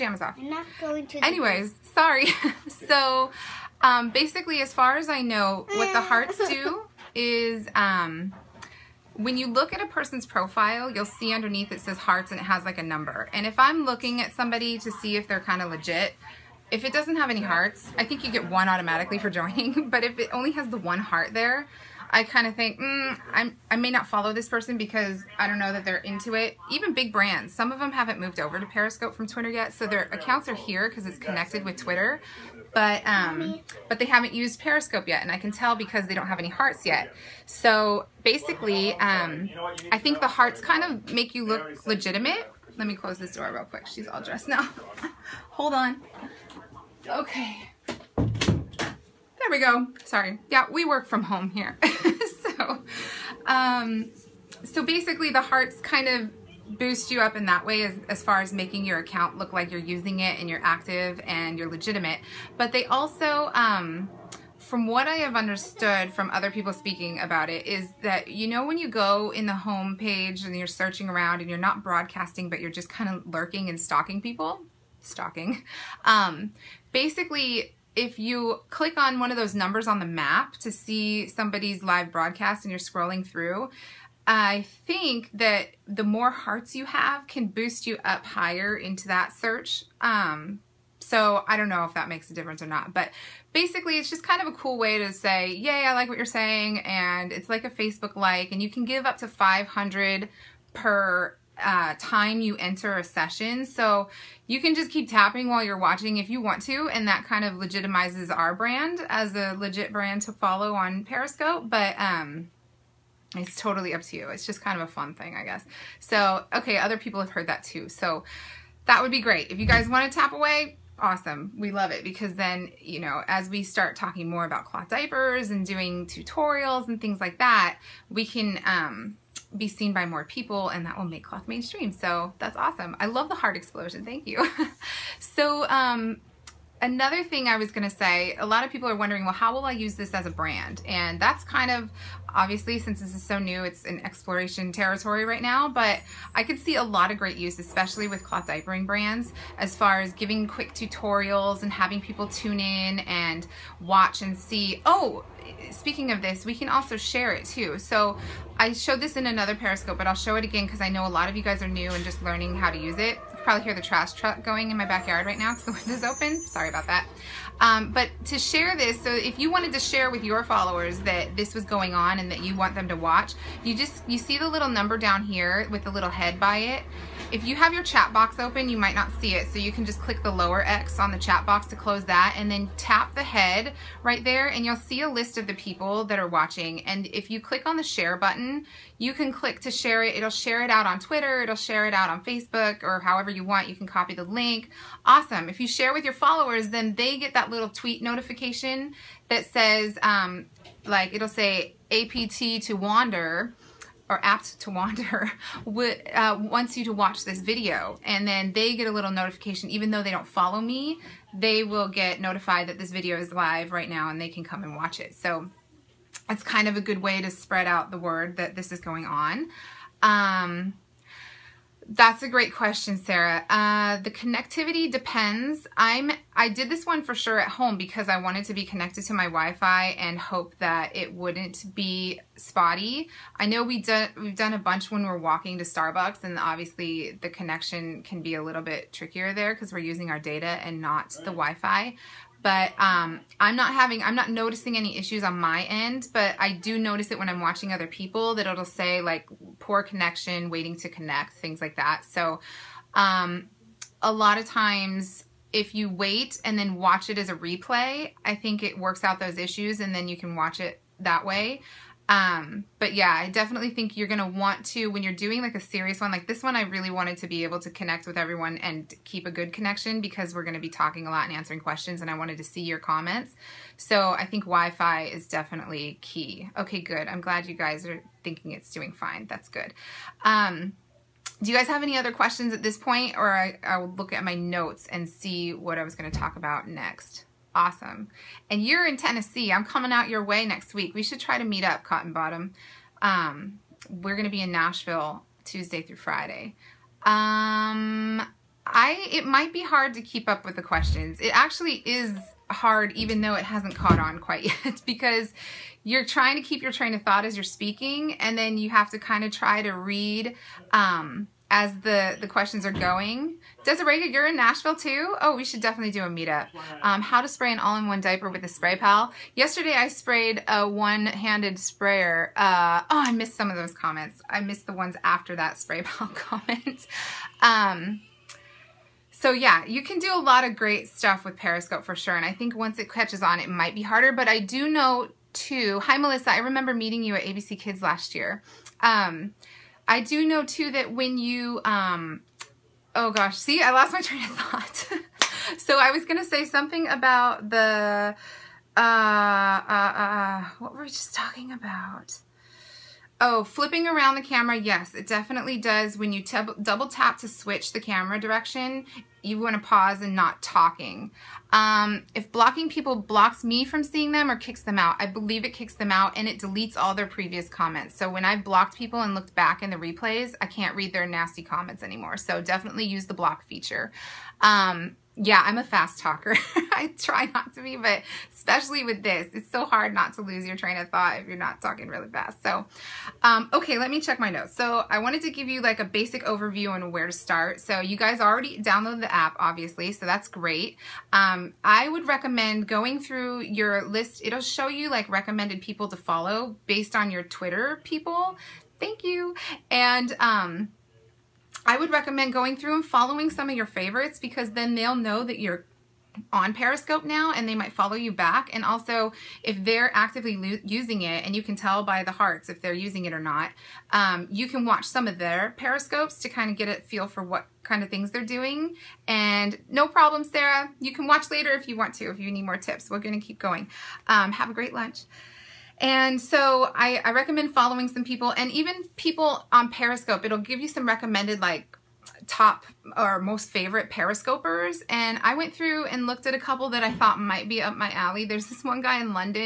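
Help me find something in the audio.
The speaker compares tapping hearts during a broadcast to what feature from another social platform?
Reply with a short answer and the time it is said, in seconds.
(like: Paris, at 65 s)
a Facebook like, at 97 s.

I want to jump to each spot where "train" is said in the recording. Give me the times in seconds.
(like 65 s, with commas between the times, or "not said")
306 s, 344 s, 380 s.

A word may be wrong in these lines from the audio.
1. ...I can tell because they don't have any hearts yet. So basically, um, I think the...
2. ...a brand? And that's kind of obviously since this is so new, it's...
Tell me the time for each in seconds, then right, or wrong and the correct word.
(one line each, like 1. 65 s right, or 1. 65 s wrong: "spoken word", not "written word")
1. 35 s right
2. 140 s right.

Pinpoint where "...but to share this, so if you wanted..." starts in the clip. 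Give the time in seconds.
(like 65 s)
167 s.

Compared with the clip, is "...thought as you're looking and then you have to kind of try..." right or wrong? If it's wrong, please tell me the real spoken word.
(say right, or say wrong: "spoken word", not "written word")
wrong: "speaking", not "looking".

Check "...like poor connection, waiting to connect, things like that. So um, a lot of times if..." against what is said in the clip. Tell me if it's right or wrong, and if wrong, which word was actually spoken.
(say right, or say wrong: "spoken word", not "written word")
right.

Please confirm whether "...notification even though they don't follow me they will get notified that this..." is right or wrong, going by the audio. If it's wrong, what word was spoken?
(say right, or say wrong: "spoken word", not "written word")
right.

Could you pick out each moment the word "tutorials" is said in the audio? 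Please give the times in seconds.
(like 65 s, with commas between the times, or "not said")
126 s, 150 s.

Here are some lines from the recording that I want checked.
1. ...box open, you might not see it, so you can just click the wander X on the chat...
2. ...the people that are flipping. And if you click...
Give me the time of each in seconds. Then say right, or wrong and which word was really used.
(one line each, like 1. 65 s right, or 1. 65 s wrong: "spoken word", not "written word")
1. 178 s wrong: "lower", not "wander"
2. 185 s wrong: "watching", not "flipping".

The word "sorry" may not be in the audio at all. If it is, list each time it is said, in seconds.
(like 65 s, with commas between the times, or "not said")
1 s, 50 s, 166 s.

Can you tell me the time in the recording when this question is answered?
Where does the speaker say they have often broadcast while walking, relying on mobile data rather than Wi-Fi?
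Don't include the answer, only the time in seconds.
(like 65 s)
235 s.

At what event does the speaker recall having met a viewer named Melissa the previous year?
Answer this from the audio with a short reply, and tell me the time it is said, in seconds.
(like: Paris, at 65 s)
ABC Kids, at 337 s.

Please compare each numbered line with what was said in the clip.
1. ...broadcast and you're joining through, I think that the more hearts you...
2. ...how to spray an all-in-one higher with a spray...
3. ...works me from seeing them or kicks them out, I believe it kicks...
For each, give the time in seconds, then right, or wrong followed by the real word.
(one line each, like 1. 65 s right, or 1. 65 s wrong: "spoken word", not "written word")
1. 82 s wrong: "scrolling", not "joining"
2. 317 s wrong: "diaper", not "higher"
3. 362 s wrong: "blocks", not "works".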